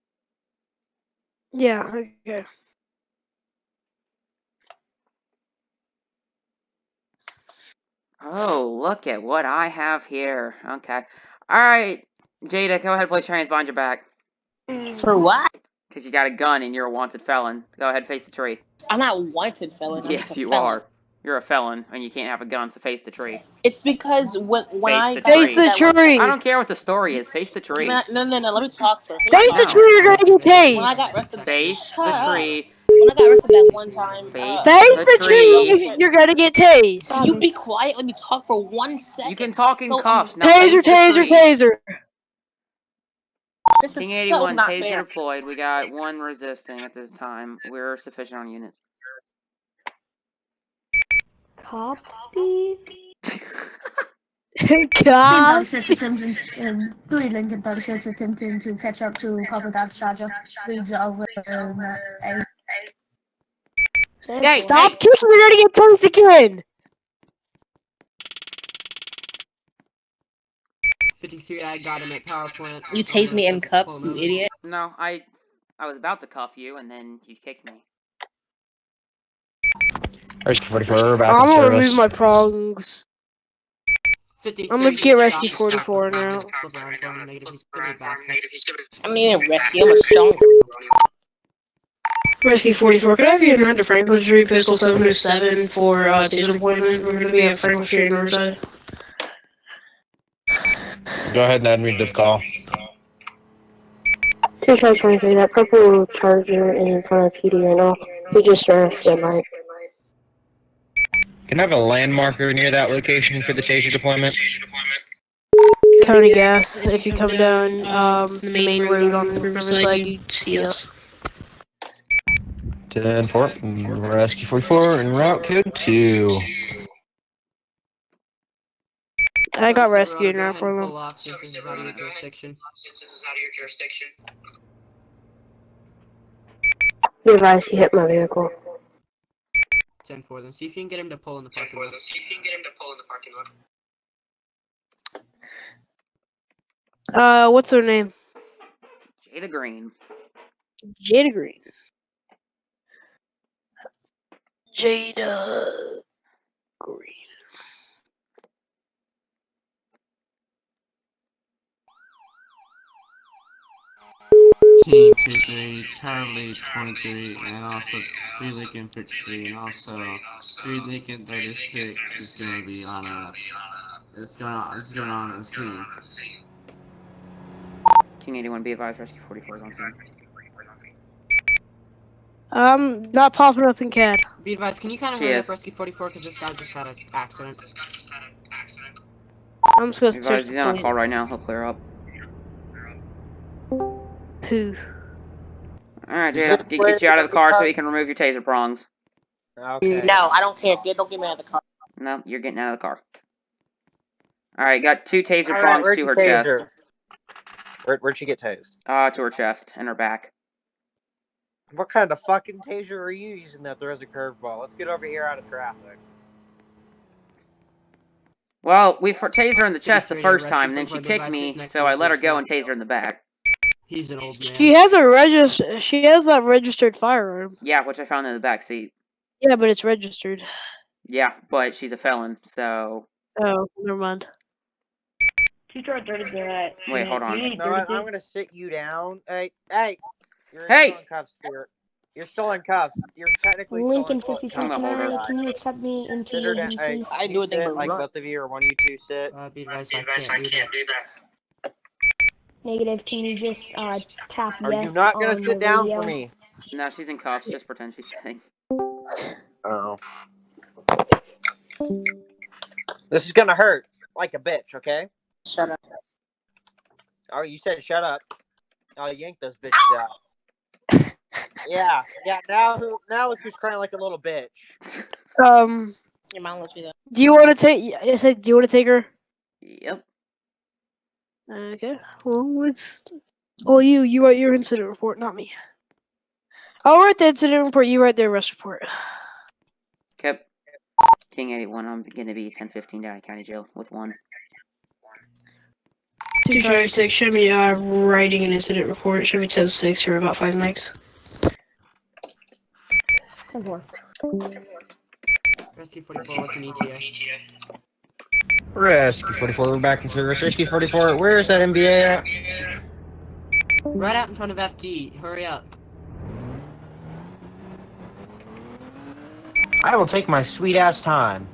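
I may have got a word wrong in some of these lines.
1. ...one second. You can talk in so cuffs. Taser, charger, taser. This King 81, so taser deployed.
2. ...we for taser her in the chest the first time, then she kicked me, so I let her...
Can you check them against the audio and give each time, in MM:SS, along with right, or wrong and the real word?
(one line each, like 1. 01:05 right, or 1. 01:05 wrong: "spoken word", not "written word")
1. 00:38 wrong: "taser", not "charger"
2. 03:39 right.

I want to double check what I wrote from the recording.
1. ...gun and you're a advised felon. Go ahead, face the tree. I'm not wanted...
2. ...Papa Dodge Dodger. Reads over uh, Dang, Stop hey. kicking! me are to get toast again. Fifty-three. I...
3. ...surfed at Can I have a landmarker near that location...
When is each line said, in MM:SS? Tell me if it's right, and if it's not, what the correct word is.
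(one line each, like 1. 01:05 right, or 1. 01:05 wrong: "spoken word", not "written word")
1. 00:16 wrong: "wanted", not "advised"
2. 00:59 right
3. 01:48 right.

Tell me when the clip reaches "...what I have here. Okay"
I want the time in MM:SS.
00:09.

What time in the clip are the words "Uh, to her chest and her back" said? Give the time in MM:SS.
03:28.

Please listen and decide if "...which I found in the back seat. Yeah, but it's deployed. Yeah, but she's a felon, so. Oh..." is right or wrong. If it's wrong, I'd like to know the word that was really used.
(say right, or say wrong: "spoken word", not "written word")
wrong: "registered", not "deployed".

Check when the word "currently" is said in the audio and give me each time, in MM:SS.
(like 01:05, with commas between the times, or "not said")
02:46.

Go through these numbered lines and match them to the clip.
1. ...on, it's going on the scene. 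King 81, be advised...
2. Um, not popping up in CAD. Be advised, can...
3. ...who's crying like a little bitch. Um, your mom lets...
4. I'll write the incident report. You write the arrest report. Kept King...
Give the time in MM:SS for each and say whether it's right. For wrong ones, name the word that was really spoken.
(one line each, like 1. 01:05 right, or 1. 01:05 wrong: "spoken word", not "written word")
1. 02:54 right
2. 03:02 right
3. 04:33 right
4. 04:46 right.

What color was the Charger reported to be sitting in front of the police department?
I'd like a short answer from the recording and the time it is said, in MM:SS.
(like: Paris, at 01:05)
Purple, at 01:45.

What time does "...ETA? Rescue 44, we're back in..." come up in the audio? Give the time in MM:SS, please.
05:06.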